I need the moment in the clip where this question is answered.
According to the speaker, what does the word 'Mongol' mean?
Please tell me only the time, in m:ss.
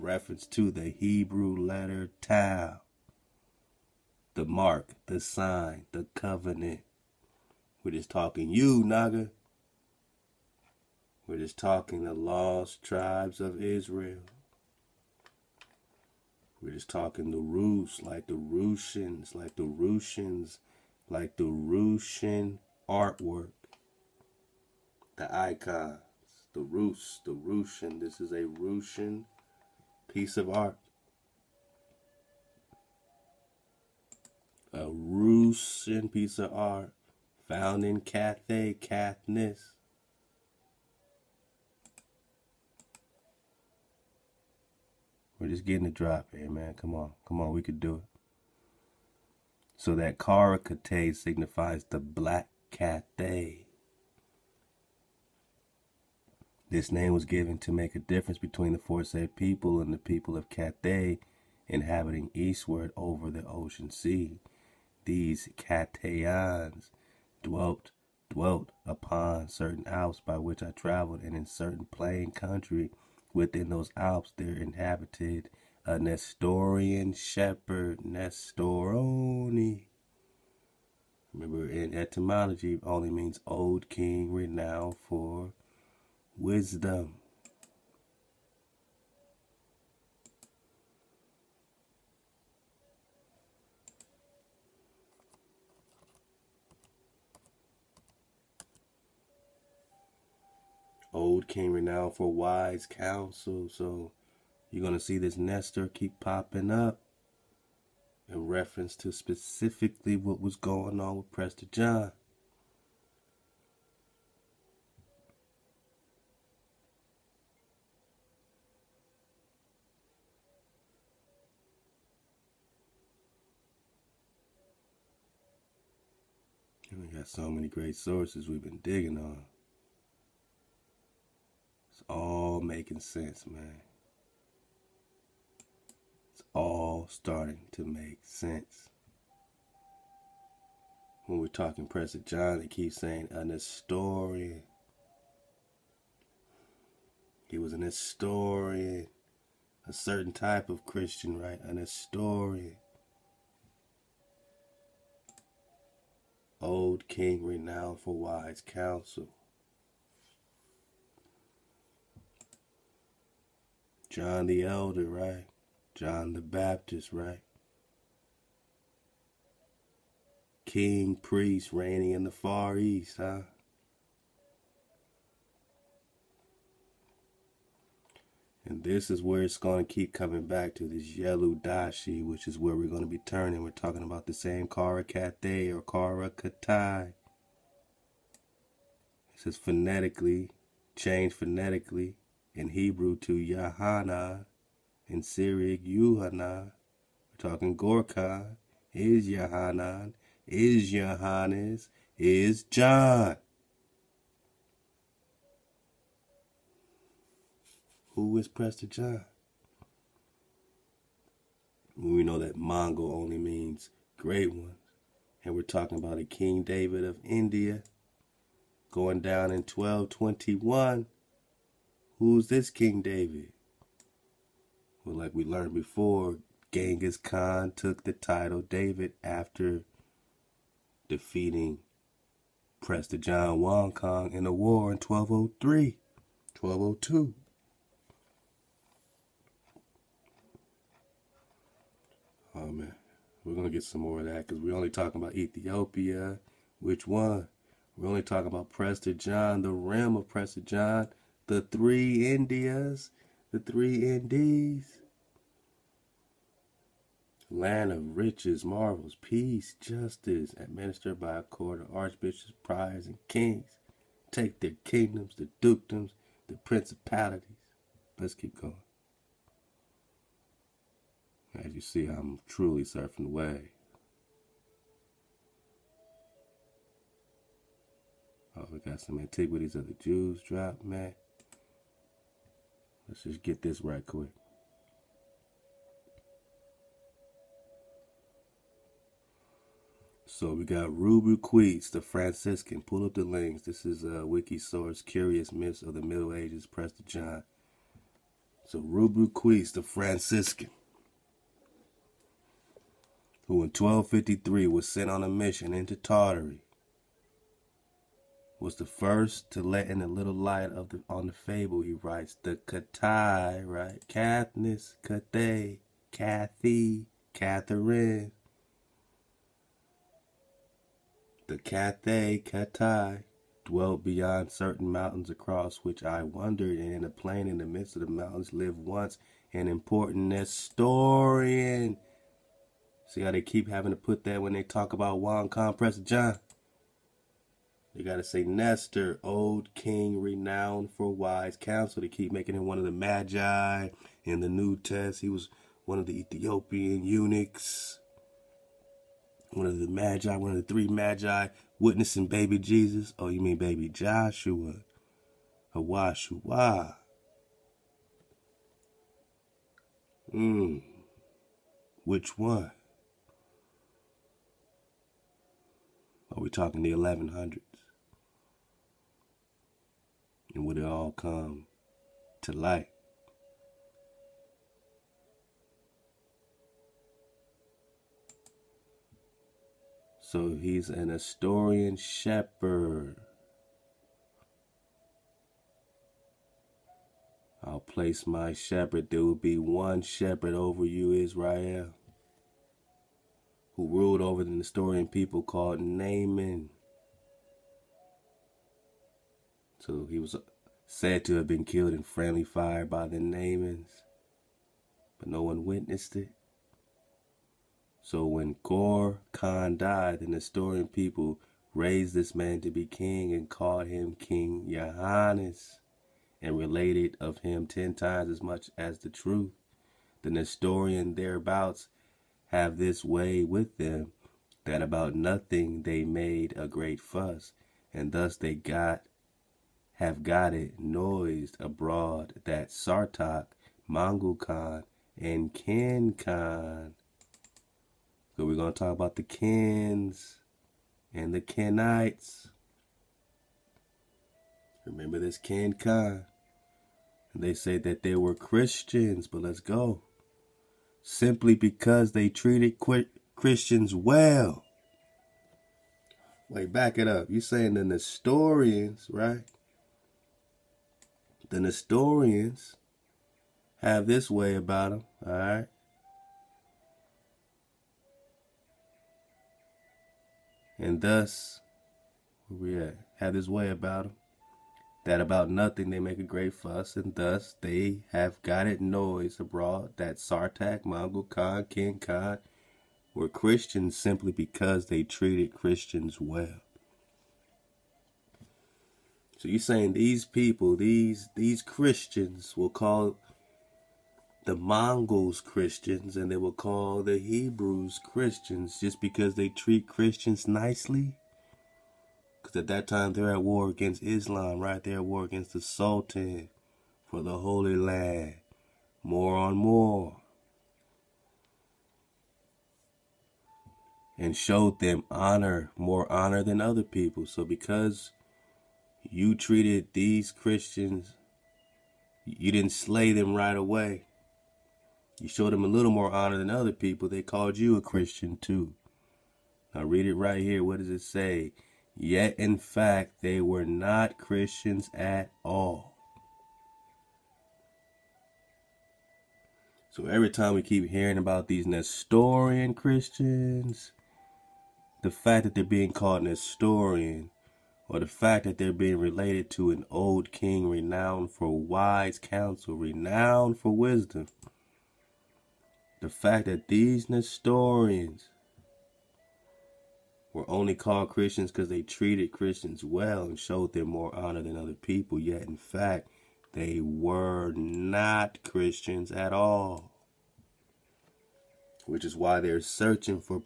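3:34.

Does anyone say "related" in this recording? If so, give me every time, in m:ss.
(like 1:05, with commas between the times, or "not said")
6:56, 9:08.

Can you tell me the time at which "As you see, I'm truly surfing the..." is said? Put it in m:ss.
4:31.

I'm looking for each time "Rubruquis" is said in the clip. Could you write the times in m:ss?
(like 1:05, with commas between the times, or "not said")
4:50, 4:58.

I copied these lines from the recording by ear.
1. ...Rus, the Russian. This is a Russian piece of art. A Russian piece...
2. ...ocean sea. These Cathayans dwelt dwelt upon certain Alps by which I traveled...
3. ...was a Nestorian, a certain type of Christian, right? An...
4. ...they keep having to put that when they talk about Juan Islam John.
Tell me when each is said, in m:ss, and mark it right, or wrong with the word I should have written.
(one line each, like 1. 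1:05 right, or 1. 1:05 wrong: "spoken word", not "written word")
1. 0:26 right
2. 1:03 right
3. 2:27 right
4. 5:33 wrong: "Compressor", not "Islam".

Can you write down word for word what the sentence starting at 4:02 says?
Oh man, we're gonna get some more of that because we're only talking about Ethiopia.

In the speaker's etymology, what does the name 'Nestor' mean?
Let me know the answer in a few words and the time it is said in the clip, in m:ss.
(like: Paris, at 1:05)
old king renowned for wisdom, at 1:23.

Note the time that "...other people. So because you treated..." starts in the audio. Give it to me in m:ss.
8:36.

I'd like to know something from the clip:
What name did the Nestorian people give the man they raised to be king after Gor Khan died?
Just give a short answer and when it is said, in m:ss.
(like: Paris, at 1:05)
King Johannes, at 6:54.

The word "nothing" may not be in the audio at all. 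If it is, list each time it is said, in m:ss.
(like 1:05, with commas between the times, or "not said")
7:05, 7:55.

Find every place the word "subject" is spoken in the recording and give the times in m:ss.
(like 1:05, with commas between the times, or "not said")
not said.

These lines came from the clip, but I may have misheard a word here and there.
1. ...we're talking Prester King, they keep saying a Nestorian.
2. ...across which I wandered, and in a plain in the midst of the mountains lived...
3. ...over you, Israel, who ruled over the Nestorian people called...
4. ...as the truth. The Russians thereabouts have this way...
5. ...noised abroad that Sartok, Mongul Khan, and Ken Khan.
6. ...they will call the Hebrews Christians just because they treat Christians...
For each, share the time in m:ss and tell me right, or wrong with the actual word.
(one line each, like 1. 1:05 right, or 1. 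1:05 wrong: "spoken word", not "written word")
1. 2:21 wrong: "John", not "King"
2. 5:25 right
3. 6:30 right
4. 6:58 wrong: "Nestorian", not "Russians"
5. 7:10 right
6. 8:16 right.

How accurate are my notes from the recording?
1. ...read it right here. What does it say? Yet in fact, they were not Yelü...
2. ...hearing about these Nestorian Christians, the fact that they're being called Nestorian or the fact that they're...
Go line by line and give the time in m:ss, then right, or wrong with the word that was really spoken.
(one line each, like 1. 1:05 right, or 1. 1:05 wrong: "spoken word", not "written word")
1. 8:49 wrong: "Christians", not "Yelü"
2. 9:00 right.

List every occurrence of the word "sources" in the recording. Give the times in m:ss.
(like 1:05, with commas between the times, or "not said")
2:07, 4:54.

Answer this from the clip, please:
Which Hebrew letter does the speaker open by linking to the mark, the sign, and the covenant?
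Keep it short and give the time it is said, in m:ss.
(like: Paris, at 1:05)
Tau, at 0:02.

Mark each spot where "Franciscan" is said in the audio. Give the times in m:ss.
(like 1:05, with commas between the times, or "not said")
4:52, 4:59.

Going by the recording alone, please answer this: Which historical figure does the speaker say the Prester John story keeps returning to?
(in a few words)
Yelü Dashi.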